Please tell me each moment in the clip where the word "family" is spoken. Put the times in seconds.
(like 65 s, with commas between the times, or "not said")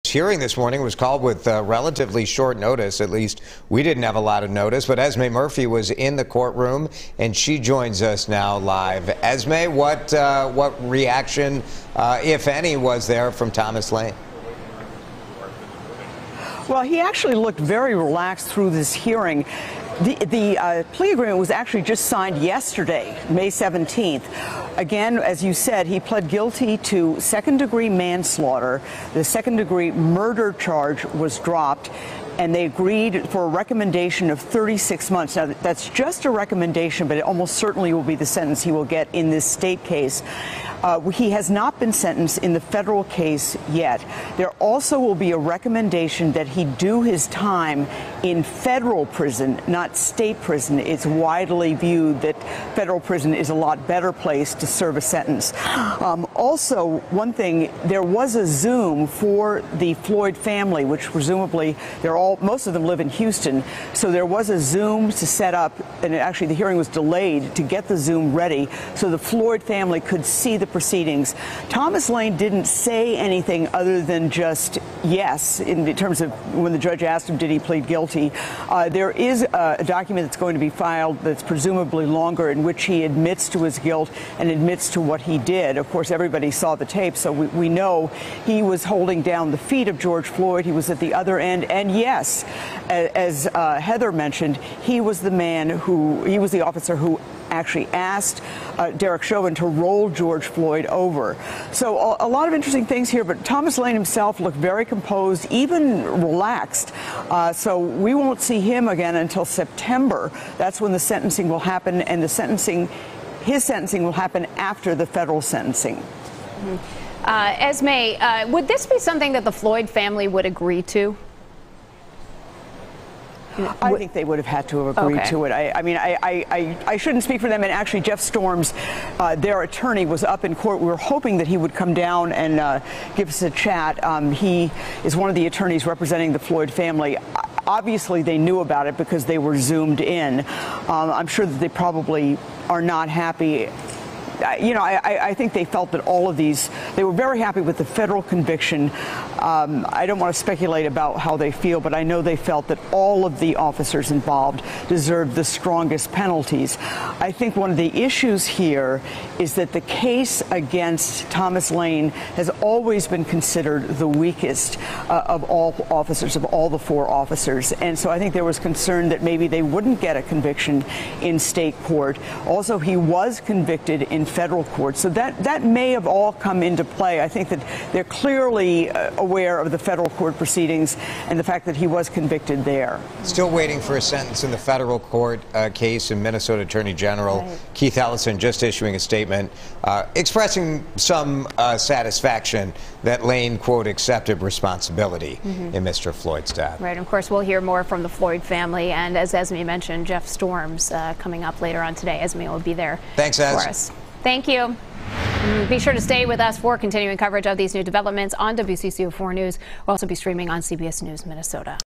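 60 s, 69 s, 119 s, 136 s, 198 s.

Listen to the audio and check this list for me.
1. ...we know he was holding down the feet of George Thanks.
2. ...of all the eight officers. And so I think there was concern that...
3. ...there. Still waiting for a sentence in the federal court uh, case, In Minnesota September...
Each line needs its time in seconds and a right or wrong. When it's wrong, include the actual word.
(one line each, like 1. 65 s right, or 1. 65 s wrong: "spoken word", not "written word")
1. 87 s wrong: "Floyd", not "Thanks"
2. 166 s wrong: "four", not "eight"
3. 182 s wrong: "Attorney", not "September".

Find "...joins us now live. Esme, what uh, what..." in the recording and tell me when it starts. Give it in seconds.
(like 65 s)
7 s.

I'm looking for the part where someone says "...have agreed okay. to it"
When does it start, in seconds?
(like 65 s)
124 s.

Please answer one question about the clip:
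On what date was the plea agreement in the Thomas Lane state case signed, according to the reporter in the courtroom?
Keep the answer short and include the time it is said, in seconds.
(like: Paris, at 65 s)
May 17, at 23 s.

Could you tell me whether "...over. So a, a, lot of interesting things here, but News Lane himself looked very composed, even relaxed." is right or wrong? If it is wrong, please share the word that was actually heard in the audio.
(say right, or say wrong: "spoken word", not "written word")
wrong: "Thomas", not "News".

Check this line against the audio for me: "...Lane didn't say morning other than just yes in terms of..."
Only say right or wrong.
wrong.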